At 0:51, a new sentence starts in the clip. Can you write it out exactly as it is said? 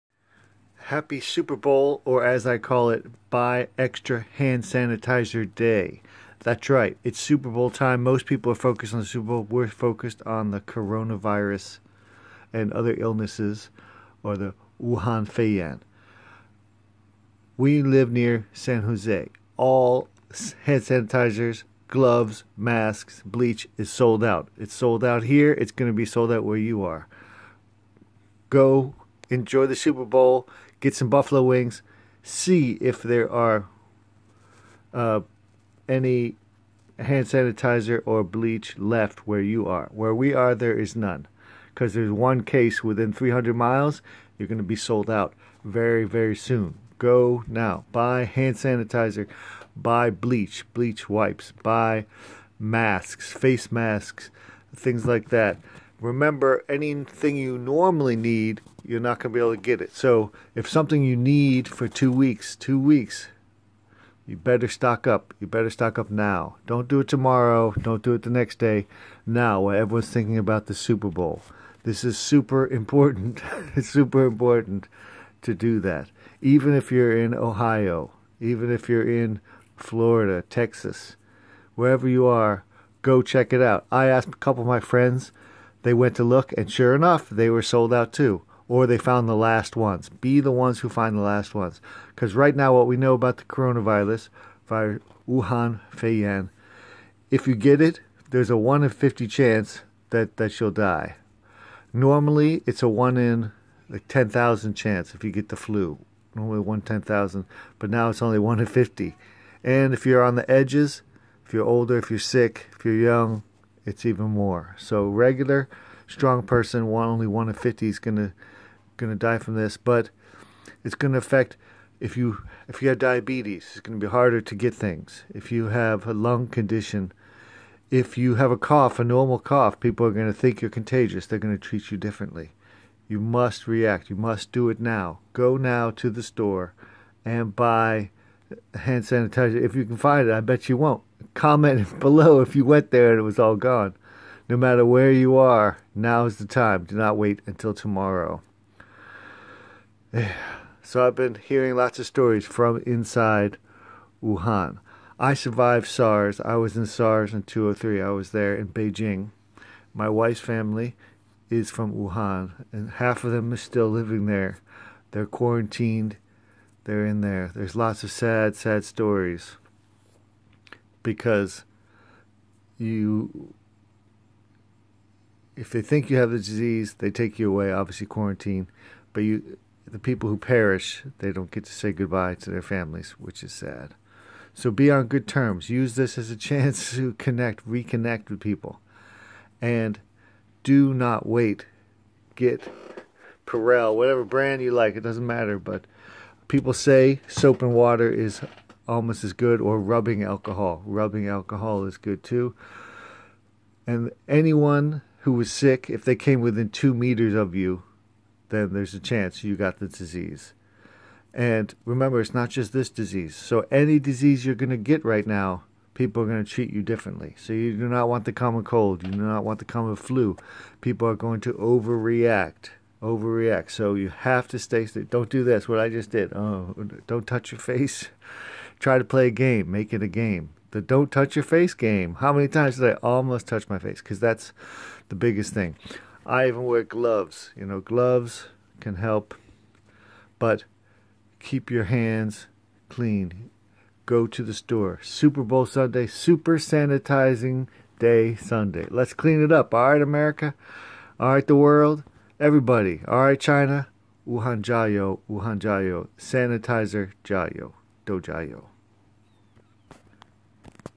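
Buy masks, face masks, things like that.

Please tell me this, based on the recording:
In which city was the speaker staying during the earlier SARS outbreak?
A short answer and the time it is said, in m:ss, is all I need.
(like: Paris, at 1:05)
Beijing, at 2:38.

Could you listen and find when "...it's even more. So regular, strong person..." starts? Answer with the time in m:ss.
1:53.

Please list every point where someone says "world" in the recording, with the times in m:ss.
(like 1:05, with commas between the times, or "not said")
4:11.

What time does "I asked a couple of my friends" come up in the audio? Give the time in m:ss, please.
1:23.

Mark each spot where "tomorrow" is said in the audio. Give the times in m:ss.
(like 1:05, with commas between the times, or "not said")
1:07, 2:27.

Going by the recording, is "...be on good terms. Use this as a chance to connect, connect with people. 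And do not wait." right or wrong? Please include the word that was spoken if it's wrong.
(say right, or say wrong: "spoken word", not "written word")
wrong: "reconnect", not "connect".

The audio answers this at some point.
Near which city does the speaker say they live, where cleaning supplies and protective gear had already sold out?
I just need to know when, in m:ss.
0:18.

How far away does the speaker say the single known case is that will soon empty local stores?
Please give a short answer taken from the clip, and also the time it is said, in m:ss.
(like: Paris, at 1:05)
300 miles, at 0:43.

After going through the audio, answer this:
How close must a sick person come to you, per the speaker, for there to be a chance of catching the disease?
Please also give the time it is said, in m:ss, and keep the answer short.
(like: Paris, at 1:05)
2 meters, at 3:26.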